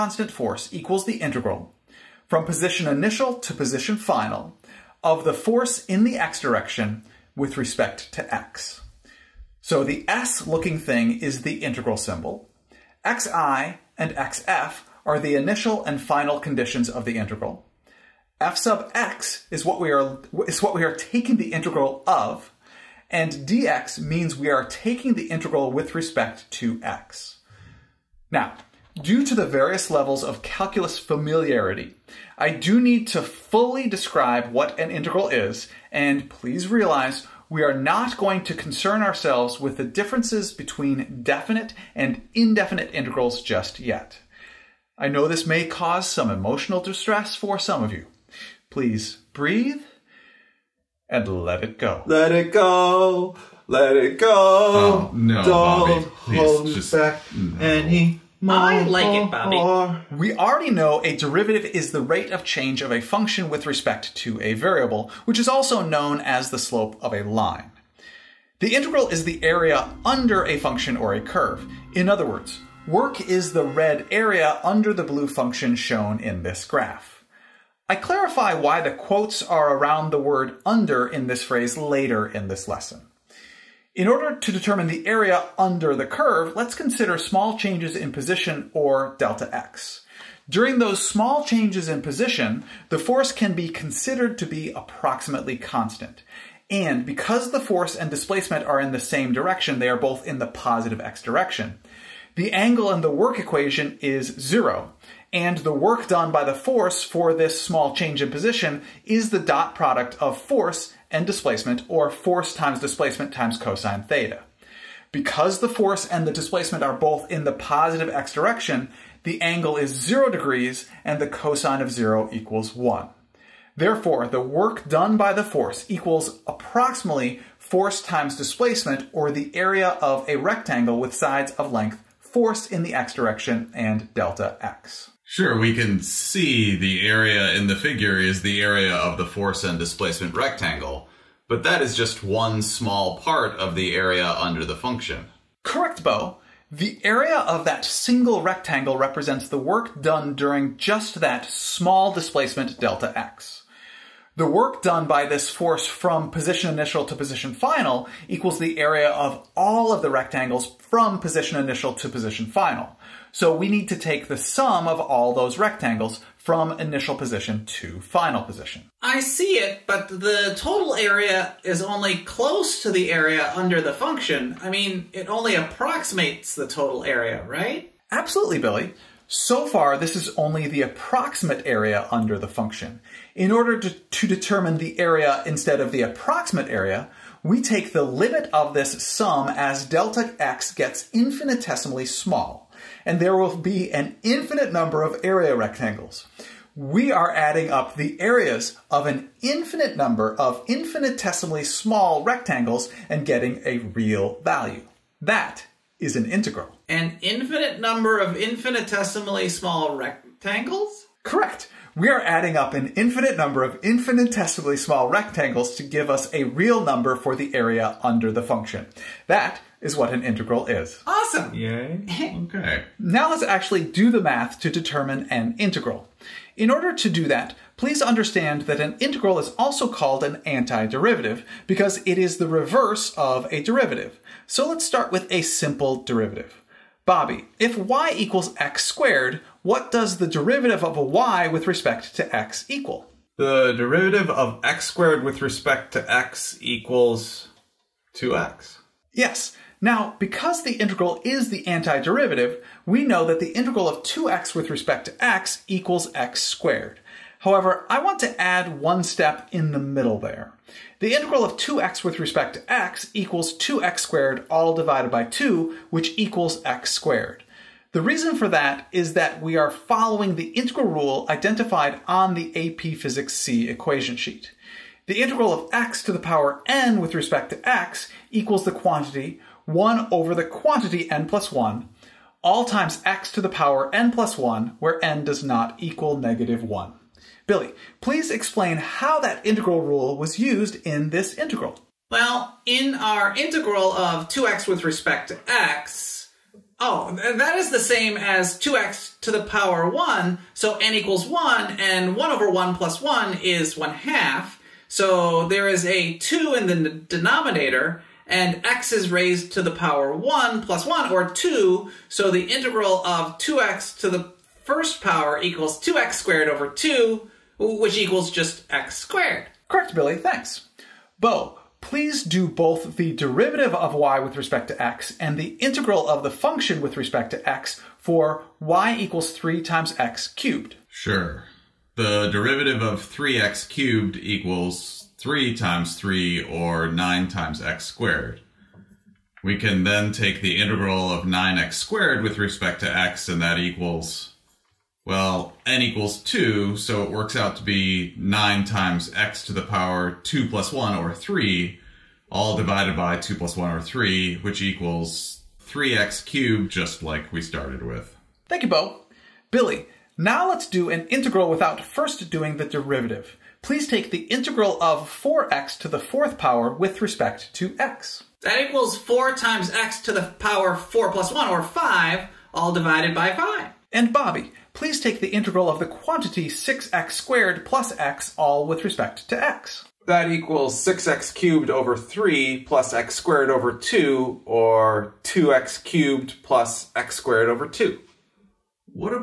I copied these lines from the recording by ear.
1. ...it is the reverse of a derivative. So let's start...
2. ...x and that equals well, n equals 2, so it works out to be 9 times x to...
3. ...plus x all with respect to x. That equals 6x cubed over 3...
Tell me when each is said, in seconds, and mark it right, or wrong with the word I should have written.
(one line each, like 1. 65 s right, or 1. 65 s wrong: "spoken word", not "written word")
1. 232 s right
2. 342 s right
3. 377 s right.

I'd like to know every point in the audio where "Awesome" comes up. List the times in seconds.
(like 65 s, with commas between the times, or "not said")
221 s.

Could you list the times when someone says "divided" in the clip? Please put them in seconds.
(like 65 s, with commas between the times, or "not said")
264 s, 352 s, 372 s.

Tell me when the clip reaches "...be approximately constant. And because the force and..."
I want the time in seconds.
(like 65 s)
94 s.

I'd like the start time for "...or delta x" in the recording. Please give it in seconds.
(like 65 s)
88 s.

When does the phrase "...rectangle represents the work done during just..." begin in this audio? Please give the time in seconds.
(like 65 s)
148 s.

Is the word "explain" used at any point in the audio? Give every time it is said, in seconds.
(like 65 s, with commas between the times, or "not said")
288 s.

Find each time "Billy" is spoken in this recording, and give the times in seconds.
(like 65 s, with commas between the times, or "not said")
178 s, 287 s, 319 s, 359 s.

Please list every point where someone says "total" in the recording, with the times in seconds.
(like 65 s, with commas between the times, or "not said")
170 s, 176 s.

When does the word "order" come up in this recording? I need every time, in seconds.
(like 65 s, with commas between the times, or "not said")
84 s, 183 s, 226 s.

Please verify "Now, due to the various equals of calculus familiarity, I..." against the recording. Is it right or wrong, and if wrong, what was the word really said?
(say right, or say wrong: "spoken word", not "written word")
wrong: "levels", not "equals".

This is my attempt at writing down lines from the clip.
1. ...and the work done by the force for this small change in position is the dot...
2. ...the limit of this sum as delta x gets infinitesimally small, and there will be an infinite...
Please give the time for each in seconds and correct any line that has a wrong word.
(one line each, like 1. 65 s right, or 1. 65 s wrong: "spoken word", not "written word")
1. 105 s right
2. 187 s right.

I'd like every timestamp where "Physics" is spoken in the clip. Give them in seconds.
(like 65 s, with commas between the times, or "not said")
272 s.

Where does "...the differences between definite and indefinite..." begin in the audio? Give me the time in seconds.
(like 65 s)
39 s.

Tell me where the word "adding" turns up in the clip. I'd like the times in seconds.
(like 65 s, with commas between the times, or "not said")
197 s, 212 s.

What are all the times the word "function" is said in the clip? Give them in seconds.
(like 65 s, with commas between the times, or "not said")
63 s, 70 s, 75 s, 144 s, 173 s, 182 s, 218 s, 326 s.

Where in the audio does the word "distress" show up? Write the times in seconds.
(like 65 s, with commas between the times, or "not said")
46 s.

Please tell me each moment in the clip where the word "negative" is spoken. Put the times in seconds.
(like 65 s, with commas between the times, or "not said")
286 s.